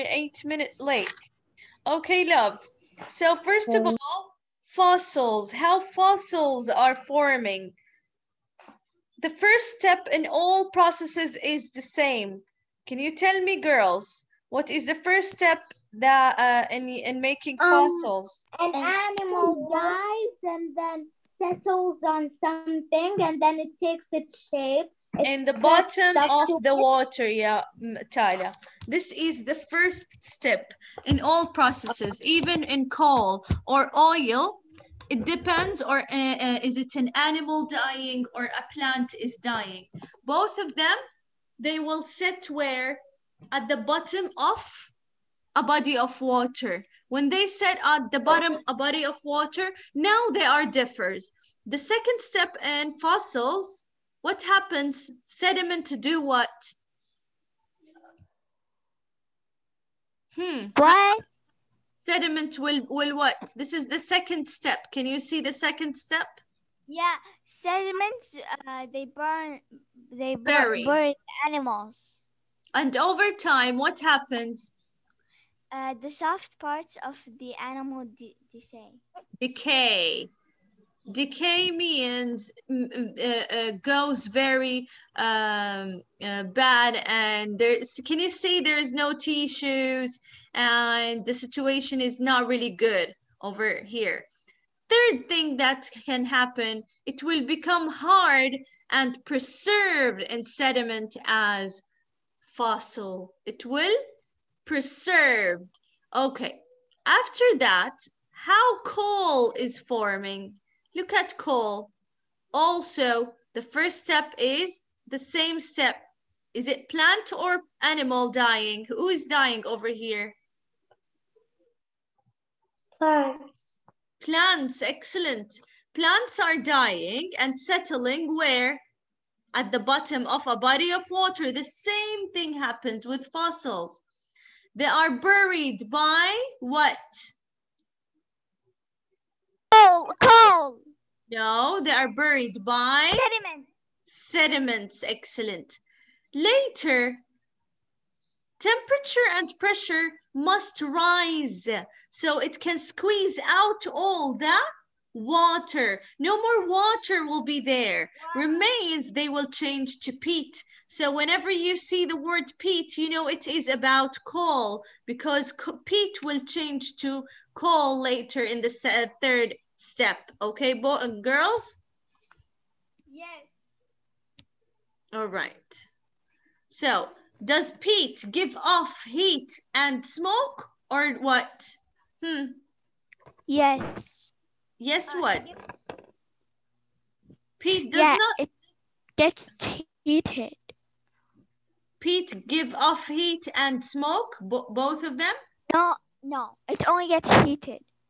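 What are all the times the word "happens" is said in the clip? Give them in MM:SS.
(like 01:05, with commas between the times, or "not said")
00:54, 01:13, 01:36, 02:12.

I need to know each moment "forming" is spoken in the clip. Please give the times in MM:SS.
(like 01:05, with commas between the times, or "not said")
00:06, 01:49.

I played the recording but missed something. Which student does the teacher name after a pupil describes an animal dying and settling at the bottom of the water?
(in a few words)
Talia.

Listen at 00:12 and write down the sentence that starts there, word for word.
Can you tell me, girls, what is the first step that uh, in in making um, fossils?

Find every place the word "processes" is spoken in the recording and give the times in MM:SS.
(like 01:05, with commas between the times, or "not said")
00:10, 00:31.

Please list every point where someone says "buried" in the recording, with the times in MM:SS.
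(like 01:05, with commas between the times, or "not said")
02:15, 02:22.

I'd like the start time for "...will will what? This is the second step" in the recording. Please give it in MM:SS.
01:02.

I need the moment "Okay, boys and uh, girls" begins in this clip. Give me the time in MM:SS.
02:50.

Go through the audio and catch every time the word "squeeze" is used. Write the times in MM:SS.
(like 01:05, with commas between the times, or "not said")
02:32.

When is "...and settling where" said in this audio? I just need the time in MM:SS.
02:07.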